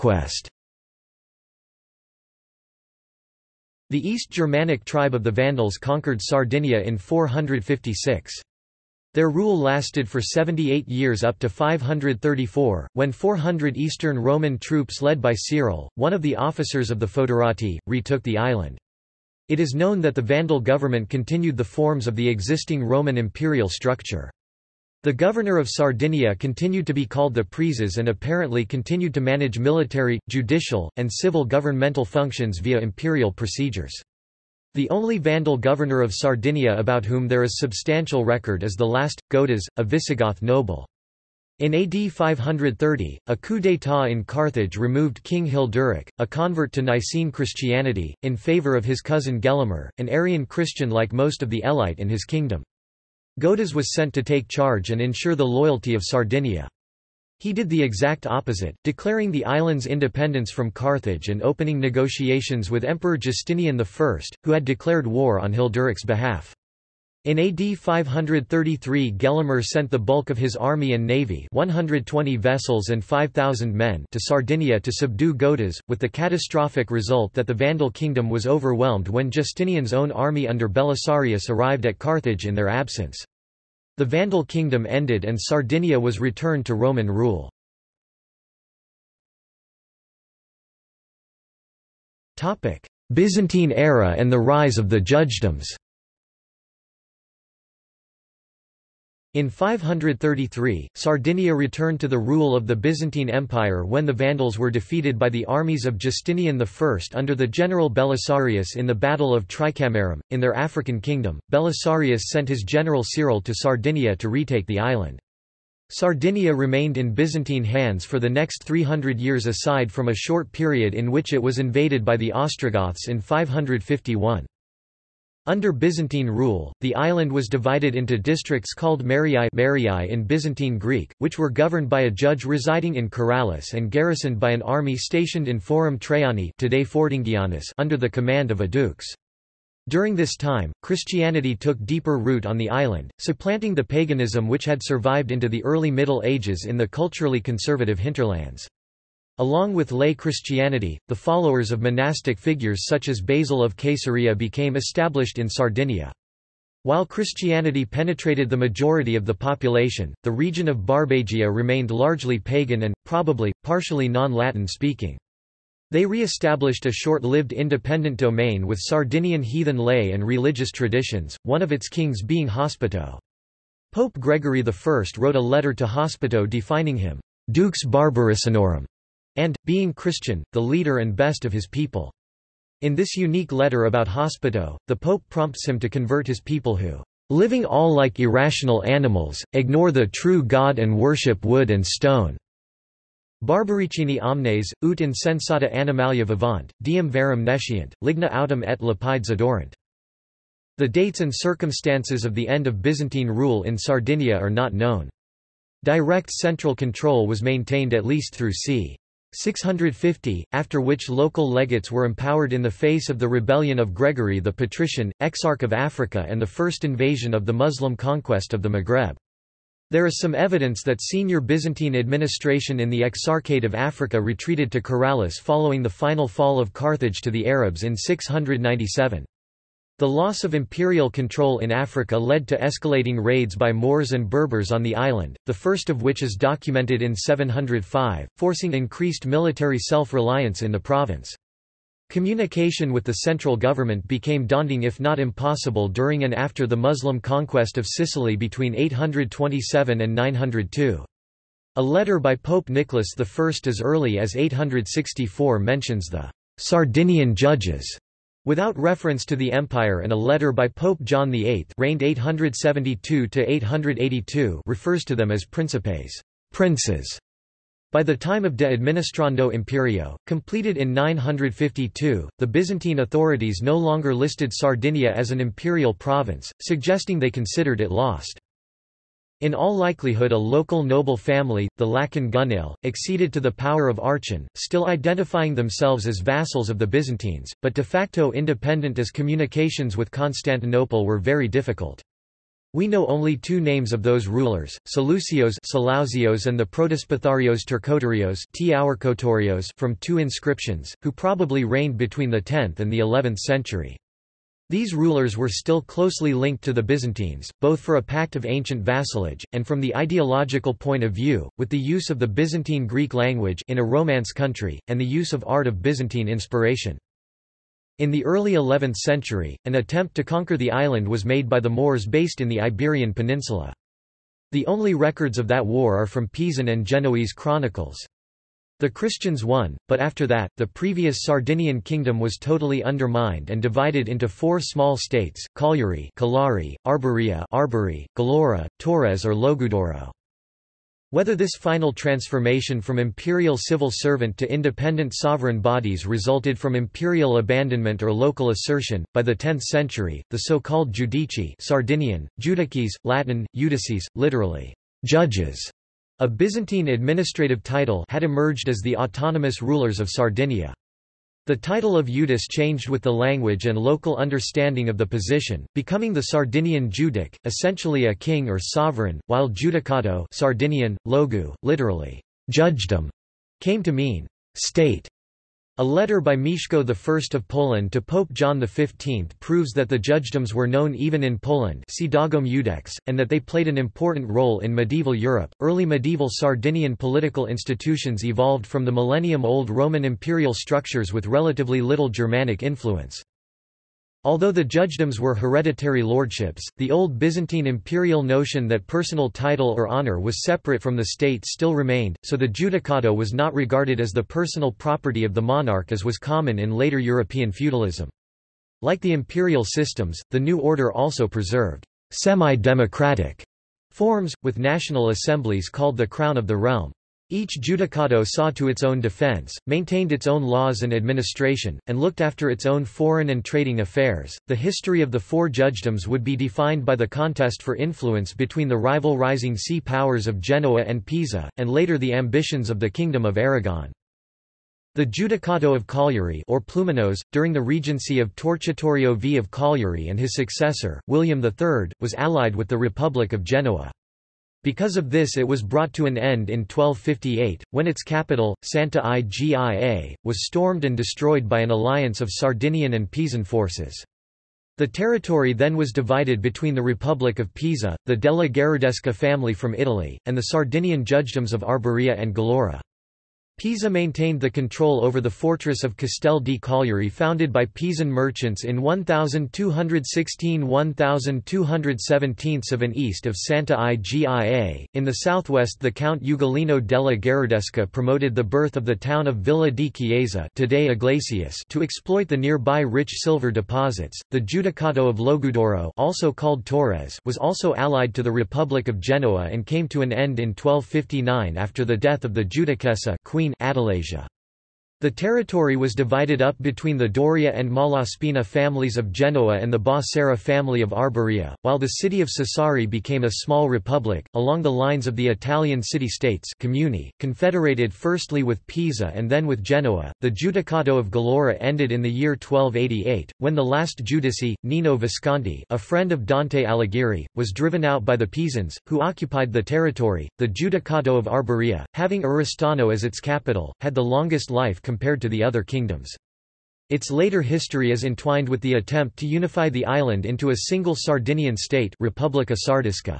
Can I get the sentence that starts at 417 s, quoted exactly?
Each judicato saw to its own defense, maintained its own laws and administration, and looked after its own foreign and trading affairs.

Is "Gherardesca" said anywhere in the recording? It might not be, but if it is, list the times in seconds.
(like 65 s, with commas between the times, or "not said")
458 s, 477 s.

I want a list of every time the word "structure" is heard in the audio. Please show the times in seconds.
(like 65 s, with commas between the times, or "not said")
23 s, 390 s.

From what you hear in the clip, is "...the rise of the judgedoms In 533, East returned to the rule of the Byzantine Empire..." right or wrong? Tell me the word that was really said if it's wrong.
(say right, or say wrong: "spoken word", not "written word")
wrong: "Sardinia", not "East".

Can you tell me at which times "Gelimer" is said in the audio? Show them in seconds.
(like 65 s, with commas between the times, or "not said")
49 s, 69 s.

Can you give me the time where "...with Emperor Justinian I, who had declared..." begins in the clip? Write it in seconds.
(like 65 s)
62 s.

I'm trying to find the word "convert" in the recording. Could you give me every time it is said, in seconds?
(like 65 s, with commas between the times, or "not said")
46 s, 185 s.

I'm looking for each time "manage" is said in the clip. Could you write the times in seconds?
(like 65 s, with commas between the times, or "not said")
29 s.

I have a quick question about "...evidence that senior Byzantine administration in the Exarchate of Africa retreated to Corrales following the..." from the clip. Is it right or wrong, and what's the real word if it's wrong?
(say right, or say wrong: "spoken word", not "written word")
right.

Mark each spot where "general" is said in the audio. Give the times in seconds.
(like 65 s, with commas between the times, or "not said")
107 s, 112 s.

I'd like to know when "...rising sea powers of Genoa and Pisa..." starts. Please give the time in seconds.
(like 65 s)
429 s.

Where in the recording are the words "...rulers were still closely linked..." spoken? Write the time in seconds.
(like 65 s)
304 s.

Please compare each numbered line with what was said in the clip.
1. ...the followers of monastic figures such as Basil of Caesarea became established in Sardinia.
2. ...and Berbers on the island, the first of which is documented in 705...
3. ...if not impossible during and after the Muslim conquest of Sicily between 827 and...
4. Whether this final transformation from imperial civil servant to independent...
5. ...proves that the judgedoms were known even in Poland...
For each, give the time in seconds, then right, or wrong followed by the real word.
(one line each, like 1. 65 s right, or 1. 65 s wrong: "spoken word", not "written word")
1. 151 s right
2. 234 s right
3. 244 s right
4. 341 s right
5. 379 s right.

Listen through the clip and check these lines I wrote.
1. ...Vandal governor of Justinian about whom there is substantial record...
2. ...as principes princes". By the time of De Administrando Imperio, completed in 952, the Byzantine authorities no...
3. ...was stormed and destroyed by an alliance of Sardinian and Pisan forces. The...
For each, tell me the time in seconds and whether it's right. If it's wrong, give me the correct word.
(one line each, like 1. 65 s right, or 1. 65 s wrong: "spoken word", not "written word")
1. 35 s wrong: "Sardinia", not "Justinian"
2. 265 s right
3. 450 s right.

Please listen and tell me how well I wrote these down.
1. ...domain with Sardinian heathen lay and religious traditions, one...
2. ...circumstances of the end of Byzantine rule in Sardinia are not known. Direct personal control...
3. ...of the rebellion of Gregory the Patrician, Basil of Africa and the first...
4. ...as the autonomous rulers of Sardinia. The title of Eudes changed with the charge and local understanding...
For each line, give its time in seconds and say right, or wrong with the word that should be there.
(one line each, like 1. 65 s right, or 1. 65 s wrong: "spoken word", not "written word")
1. 168 s right
2. 201 s wrong: "central", not "personal"
3. 213 s wrong: "Exarch", not "Basil"
4. 358 s wrong: "language", not "charge".